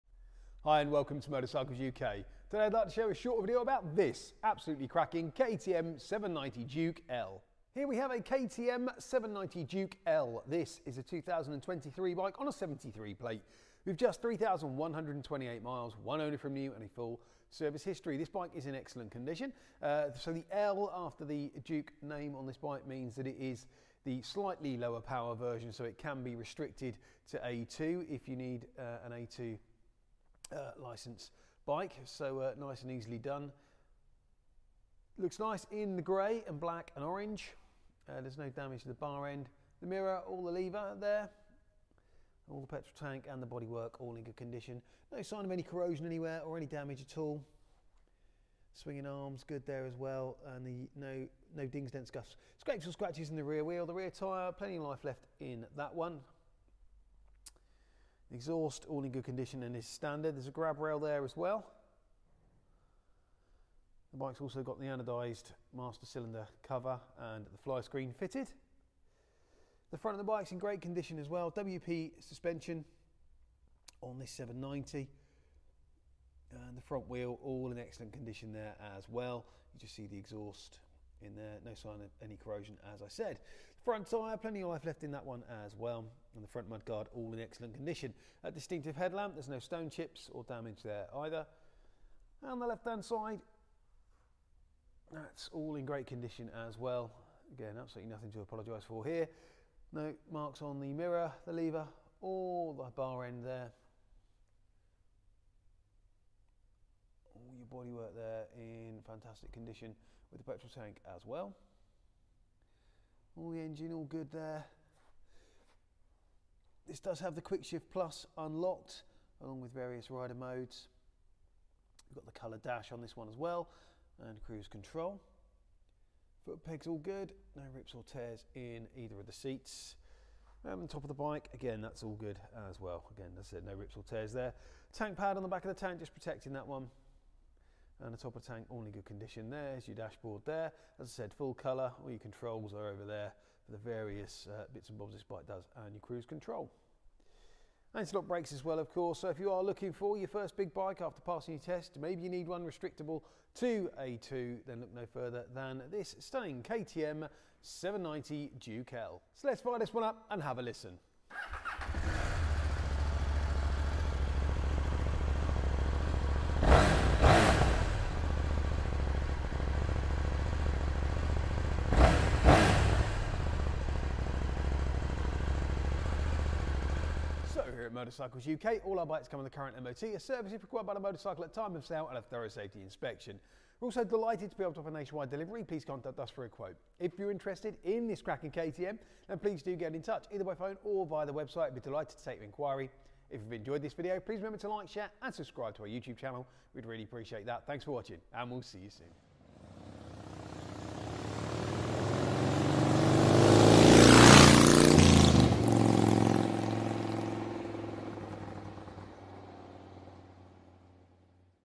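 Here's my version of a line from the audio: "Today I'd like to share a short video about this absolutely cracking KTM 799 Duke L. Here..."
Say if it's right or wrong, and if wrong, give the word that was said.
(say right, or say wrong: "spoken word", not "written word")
wrong: "790", not "799".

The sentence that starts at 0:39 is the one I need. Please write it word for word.
The mirror, all the lever there.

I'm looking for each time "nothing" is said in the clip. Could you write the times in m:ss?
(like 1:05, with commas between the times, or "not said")
1:38.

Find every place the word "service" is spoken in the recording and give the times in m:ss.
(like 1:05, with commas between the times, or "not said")
0:17, 3:00.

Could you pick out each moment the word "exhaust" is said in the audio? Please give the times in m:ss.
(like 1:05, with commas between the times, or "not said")
0:58, 1:20.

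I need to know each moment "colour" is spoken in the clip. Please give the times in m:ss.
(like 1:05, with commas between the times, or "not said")
2:02, 2:21.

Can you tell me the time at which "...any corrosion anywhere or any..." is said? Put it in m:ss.
0:45.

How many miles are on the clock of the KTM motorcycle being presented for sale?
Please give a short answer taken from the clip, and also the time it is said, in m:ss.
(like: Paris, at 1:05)
3,128, at 0:14.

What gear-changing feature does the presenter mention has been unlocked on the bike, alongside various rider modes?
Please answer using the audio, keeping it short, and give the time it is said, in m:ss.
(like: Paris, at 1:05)
quick shift plus, at 1:57.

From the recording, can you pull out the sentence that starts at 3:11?
We'd be delighted to take your inquiry.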